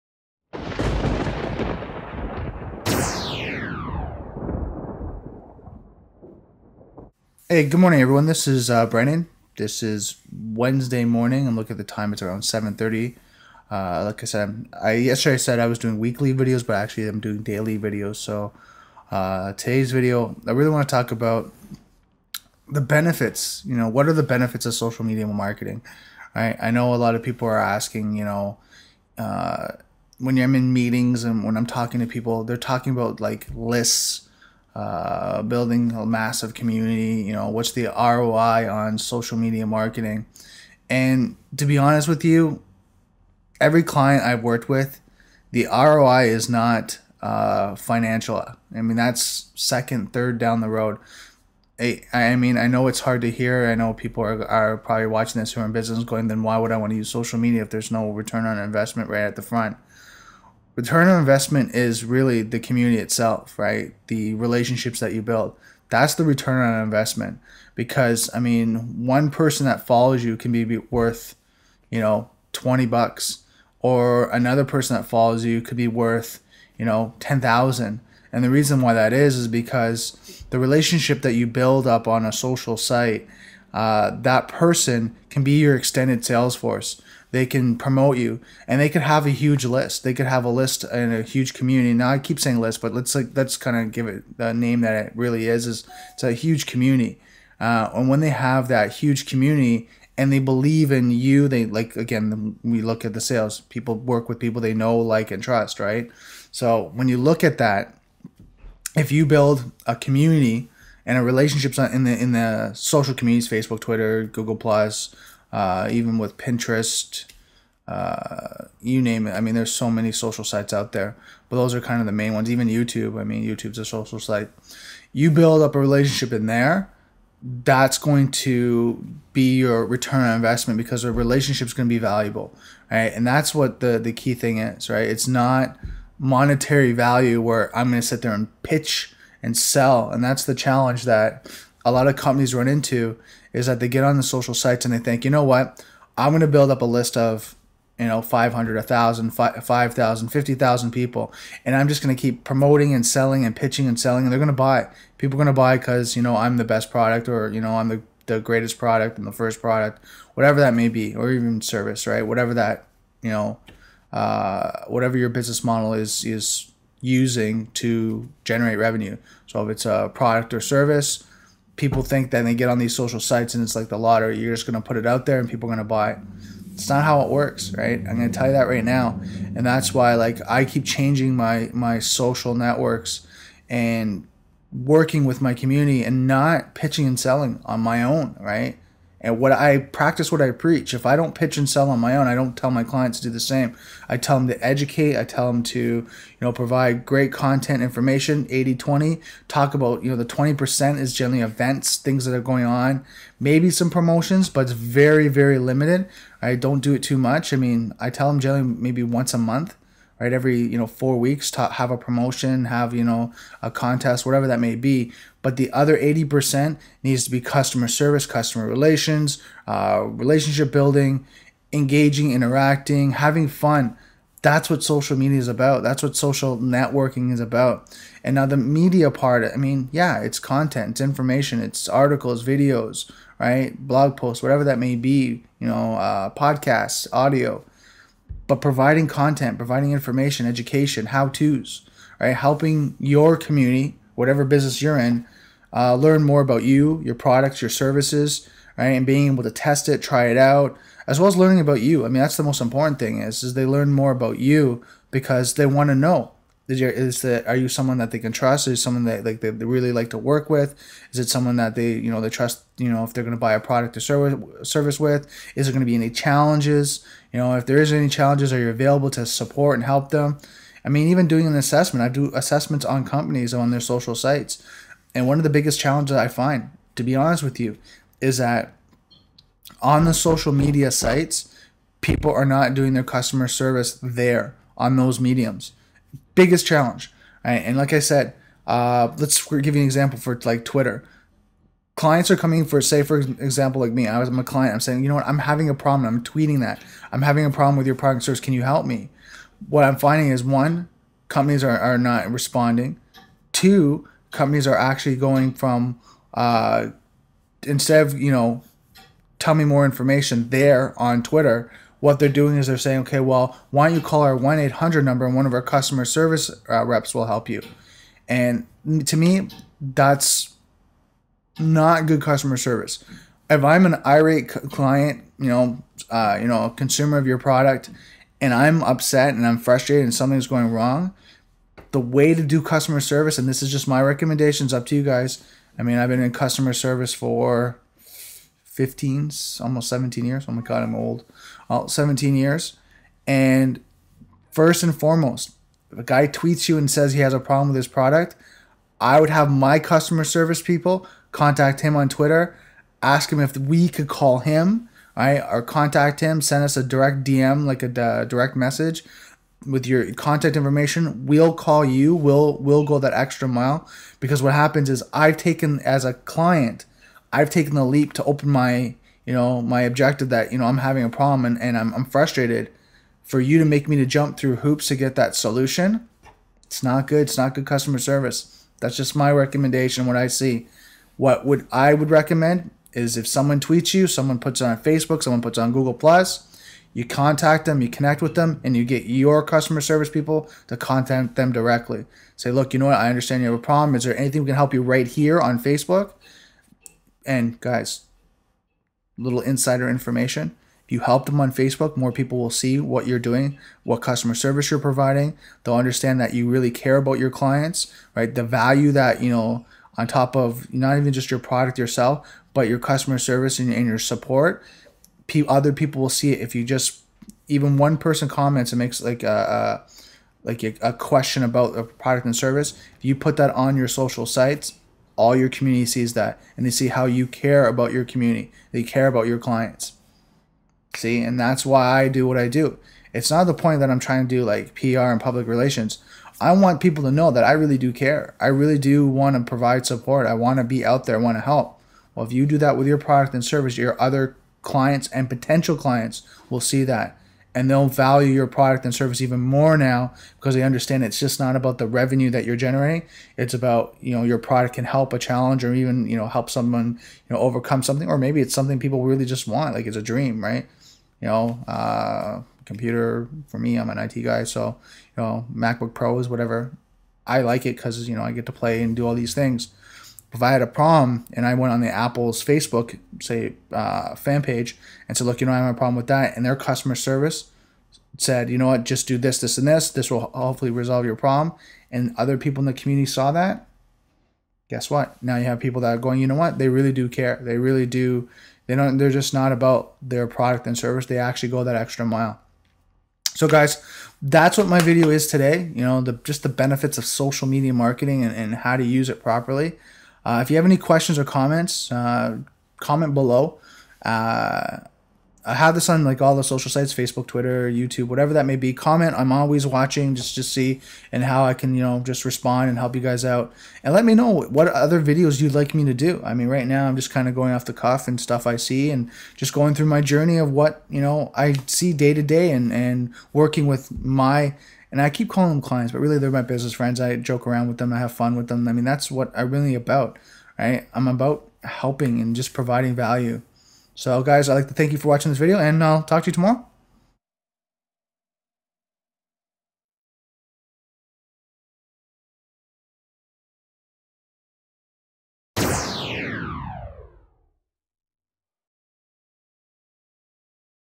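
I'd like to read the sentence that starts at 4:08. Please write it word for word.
And being able to test it, try it out, as well as learning about you.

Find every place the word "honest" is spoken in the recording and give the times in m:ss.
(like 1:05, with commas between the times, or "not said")
0:41, 4:37.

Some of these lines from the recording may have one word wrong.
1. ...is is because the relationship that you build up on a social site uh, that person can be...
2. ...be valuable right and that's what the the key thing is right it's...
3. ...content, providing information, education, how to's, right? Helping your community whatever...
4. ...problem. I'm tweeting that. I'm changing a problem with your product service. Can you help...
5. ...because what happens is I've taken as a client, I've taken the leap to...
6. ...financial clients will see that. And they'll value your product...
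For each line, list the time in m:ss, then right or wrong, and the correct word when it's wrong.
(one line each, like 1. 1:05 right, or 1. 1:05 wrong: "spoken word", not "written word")
1. 1:19 right
2. 2:11 right
3. 3:59 right
4. 4:55 wrong: "having", not "changing"
5. 6:04 right
6. 7:25 wrong: "potential", not "financial".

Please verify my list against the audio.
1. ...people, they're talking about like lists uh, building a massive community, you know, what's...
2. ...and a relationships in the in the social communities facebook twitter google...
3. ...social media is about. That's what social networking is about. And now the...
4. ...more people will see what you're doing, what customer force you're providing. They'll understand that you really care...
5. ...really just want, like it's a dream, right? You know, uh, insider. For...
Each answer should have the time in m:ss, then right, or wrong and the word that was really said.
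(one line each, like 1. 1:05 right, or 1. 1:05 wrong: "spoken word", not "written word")
1. 0:32 right
2. 1:51 right
3. 3:44 right
4. 6:41 wrong: "service", not "force"
5. 7:39 wrong: "computer", not "insider".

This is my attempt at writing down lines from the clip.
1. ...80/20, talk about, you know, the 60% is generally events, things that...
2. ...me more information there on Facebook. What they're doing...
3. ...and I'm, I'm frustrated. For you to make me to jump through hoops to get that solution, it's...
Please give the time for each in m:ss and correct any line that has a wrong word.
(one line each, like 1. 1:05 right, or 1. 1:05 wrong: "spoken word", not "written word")
1. 3:18 wrong: "20", not "60"
2. 5:09 wrong: "Twitter", not "Facebook"
3. 6:11 right.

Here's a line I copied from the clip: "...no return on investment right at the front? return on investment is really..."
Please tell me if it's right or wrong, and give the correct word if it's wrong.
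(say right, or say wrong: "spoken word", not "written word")
right.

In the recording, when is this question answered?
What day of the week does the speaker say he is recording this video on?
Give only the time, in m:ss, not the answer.
0:10.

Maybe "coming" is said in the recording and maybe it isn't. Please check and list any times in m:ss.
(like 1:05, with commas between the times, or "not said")
4:52.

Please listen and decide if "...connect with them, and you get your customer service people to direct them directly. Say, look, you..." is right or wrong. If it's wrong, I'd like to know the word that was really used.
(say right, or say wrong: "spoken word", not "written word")
wrong: "contact", not "direct".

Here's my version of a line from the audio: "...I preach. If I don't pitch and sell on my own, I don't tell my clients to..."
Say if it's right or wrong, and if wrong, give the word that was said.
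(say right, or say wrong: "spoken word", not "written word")
right.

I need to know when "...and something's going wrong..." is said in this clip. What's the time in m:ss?
5:30.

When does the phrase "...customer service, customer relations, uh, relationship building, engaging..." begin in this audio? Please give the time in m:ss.
3:37.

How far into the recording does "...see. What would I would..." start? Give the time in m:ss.
6:20.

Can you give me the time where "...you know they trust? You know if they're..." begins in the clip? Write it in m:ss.
4:21.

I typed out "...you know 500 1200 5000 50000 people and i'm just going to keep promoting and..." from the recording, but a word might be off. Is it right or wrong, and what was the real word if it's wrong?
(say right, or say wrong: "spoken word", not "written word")
wrong: "1000", not "1200".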